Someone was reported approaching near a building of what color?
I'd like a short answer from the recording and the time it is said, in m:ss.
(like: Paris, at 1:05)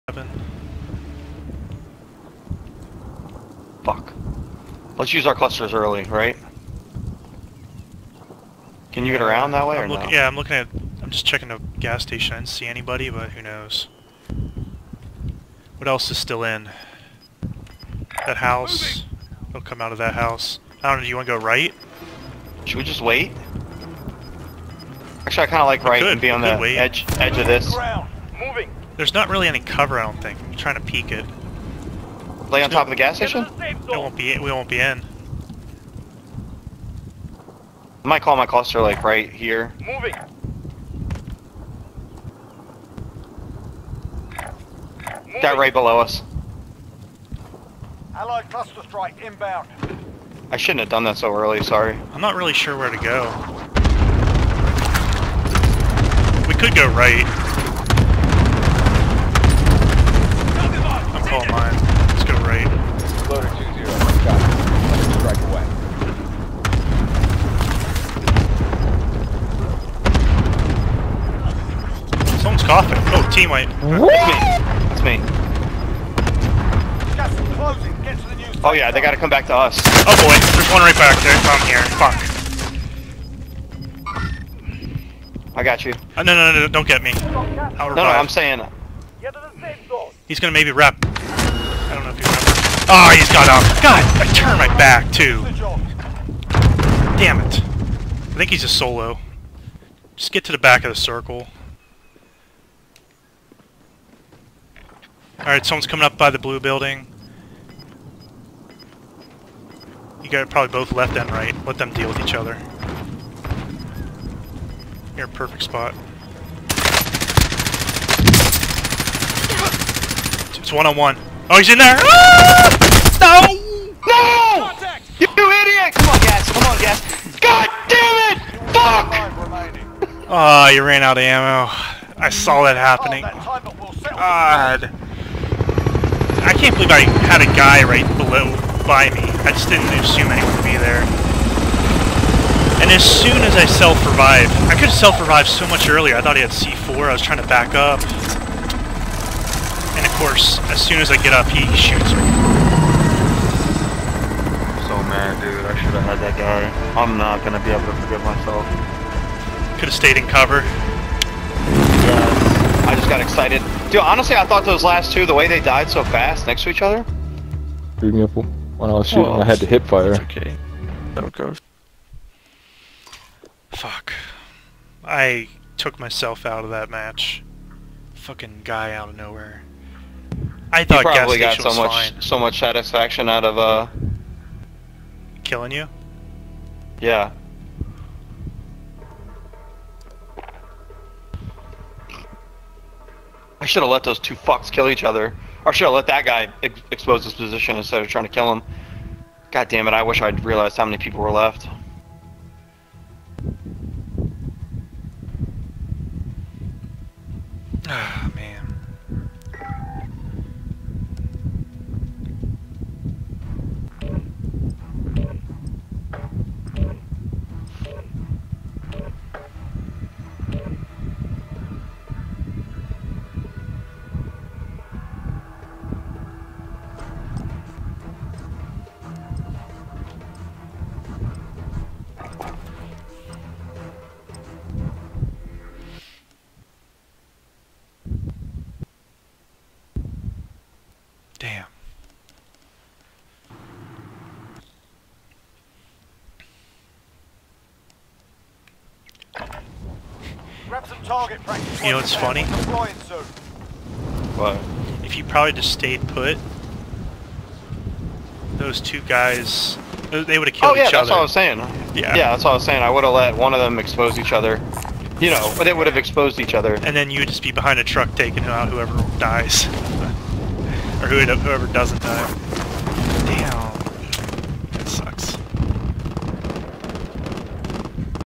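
blue, at 1:46.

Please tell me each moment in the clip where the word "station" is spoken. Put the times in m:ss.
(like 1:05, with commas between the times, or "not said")
0:12, 0:33.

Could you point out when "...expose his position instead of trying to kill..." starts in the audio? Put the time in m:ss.
3:16.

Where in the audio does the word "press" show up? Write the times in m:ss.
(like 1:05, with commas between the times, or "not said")
not said.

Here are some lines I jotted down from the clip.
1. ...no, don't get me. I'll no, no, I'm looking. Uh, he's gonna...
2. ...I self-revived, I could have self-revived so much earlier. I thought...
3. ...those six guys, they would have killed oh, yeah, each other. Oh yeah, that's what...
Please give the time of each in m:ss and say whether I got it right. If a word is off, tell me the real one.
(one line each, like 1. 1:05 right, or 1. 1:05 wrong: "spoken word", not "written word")
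1. 1:26 wrong: "saying", not "looking"
2. 2:23 right
3. 4:18 wrong: "two", not "six".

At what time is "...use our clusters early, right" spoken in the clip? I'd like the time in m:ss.
0:05.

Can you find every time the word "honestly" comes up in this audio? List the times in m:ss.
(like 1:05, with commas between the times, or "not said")
2:44.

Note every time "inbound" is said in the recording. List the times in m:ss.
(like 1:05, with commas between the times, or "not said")
0:49.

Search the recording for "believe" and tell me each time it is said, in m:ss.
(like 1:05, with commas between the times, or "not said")
2:16.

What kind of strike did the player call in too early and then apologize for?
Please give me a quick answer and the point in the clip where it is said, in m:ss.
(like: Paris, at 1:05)
cluster strike, at 0:48.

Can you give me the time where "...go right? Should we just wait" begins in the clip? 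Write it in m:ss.
0:21.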